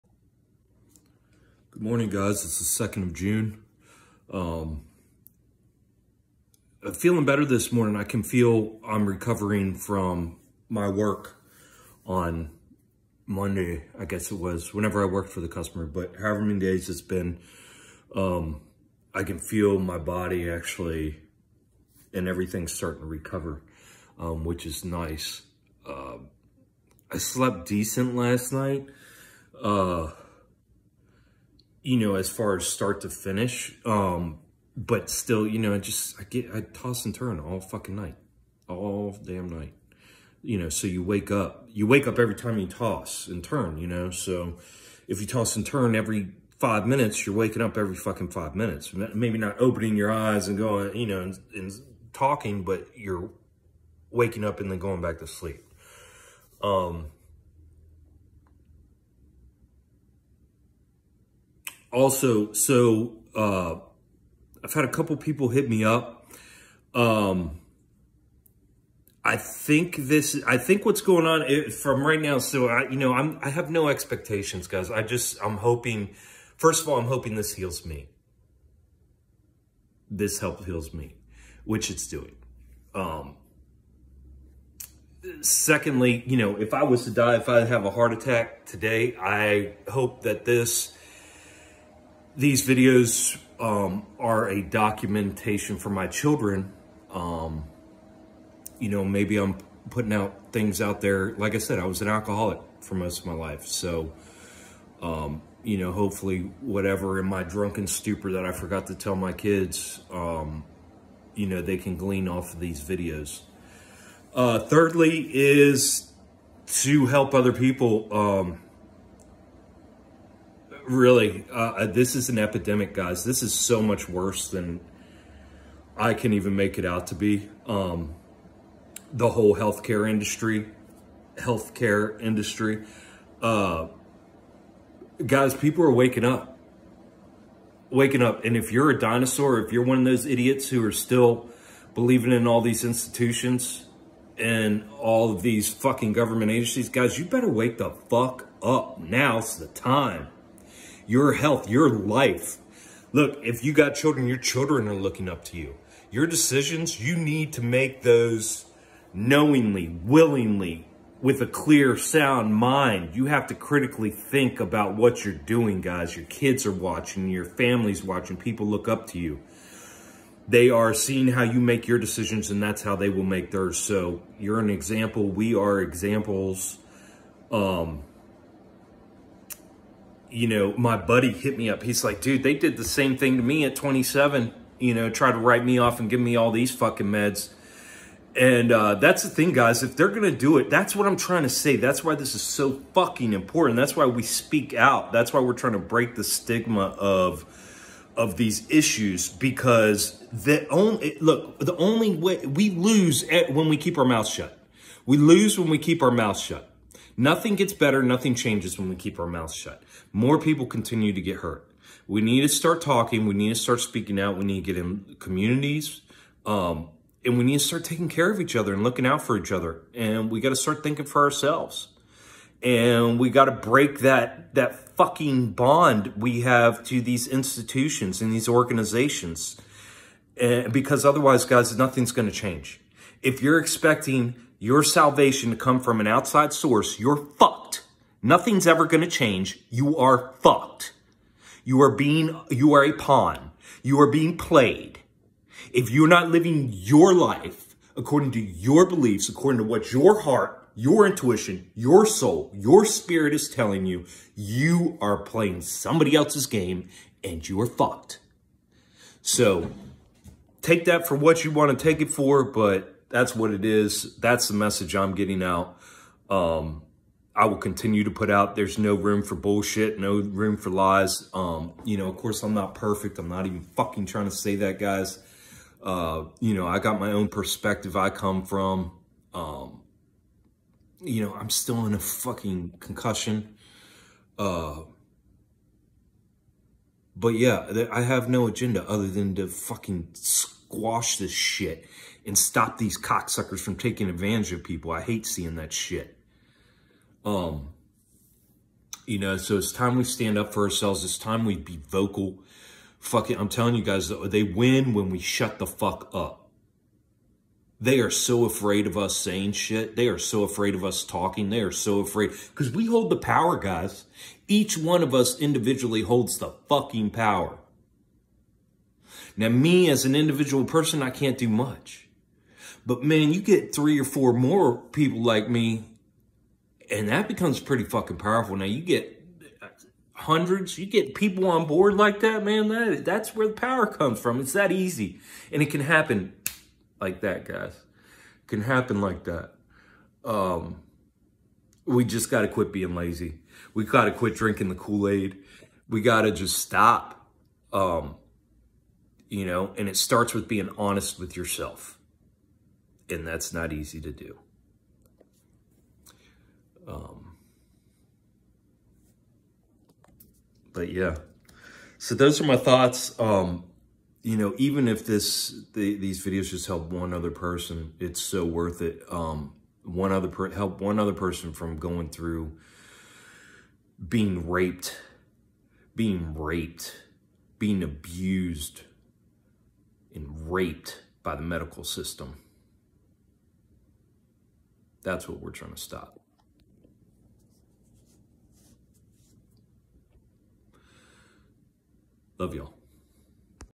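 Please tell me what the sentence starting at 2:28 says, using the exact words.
Now's the time your health, your life.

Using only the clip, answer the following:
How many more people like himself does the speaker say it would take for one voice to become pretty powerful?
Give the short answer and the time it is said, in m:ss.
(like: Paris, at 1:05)
3 or 4, at 5:23.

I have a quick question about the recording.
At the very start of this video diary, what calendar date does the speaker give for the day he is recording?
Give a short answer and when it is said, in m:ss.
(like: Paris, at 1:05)
2nd of June, at 0:02.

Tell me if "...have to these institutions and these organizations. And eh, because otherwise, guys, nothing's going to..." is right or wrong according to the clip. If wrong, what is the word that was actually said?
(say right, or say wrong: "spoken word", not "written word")
right.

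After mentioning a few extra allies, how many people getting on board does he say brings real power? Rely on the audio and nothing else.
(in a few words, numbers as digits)
Hundreds.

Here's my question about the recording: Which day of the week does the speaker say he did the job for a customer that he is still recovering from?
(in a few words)
Monday.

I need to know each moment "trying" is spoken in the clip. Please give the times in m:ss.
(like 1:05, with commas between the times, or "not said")
3:11, 3:15, 4:34, 6:25.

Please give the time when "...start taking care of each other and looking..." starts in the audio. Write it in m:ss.
3:37.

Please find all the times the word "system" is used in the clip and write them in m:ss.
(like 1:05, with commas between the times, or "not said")
6:21.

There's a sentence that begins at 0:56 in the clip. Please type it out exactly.
Um, also, so uh, I've had a couple people hit me up.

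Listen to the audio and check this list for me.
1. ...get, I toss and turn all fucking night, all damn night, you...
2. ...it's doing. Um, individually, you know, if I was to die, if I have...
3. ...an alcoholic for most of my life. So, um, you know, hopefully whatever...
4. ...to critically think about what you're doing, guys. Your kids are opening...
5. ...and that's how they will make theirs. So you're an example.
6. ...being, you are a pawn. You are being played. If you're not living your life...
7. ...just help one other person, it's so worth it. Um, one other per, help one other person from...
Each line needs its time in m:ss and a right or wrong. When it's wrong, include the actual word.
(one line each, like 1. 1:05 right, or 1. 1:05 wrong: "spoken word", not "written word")
1. 0:36 right
2. 1:21 wrong: "secondly", not "individually"
3. 1:42 right
4. 2:43 wrong: "watching", not "opening"
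5. 2:52 right
6. 4:01 right
7. 6:06 right.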